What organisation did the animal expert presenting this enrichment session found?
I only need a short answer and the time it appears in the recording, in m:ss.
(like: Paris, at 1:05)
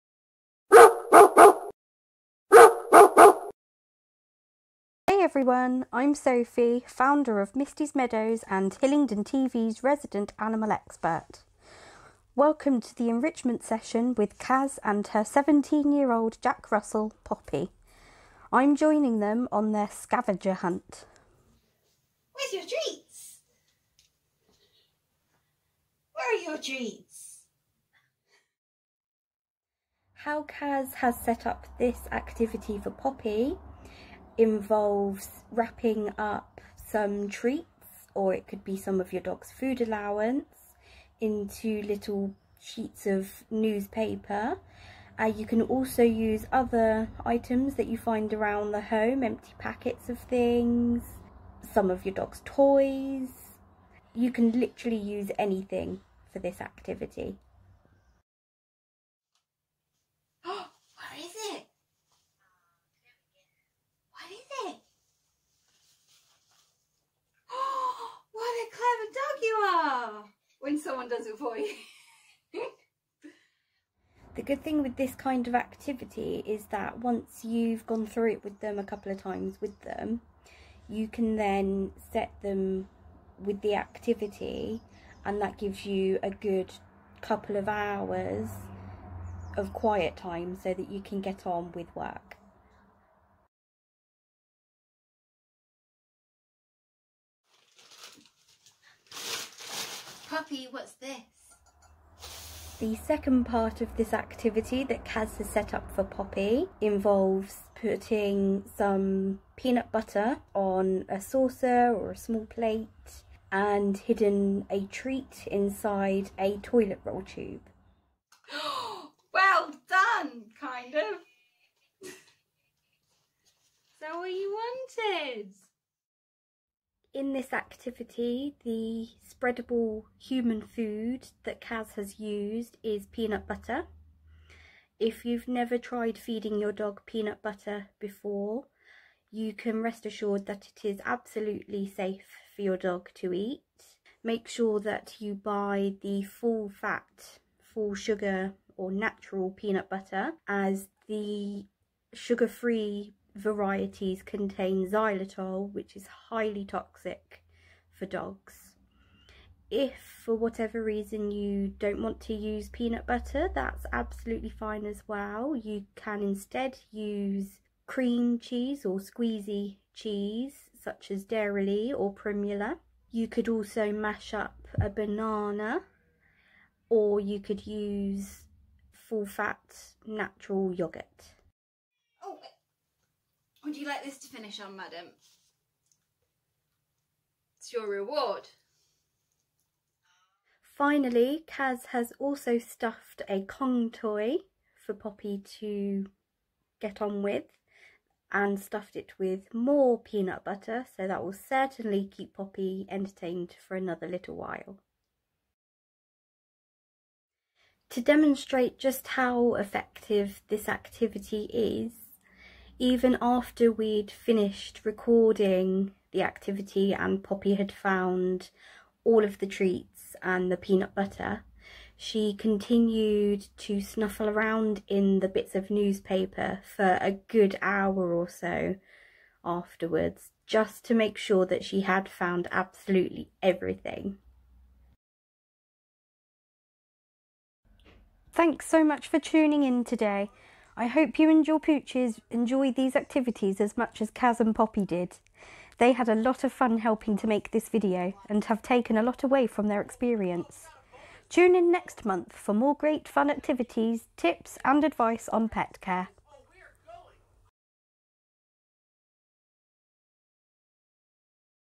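Misty's Meadows, at 0:07.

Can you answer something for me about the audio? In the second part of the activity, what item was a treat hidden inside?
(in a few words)
Toilet roll tube.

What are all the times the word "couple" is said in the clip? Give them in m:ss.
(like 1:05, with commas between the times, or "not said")
1:18, 1:27.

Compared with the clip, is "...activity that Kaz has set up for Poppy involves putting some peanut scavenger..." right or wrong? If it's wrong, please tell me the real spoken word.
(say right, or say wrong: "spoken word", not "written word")
wrong: "butter", not "scavenger".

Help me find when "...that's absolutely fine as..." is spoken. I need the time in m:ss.
2:43.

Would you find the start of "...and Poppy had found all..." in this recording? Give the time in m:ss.
3:36.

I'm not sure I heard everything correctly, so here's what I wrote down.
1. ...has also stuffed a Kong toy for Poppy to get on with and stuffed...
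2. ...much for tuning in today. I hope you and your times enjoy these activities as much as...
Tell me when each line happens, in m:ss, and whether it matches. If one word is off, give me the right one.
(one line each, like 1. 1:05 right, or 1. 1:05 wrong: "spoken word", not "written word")
1. 3:11 right
2. 3:58 wrong: "pooches", not "times".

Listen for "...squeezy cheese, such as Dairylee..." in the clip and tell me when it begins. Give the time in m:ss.
2:48.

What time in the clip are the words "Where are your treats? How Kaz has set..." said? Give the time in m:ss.
0:26.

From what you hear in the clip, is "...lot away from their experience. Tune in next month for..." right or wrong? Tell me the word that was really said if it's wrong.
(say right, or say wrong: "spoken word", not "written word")
right.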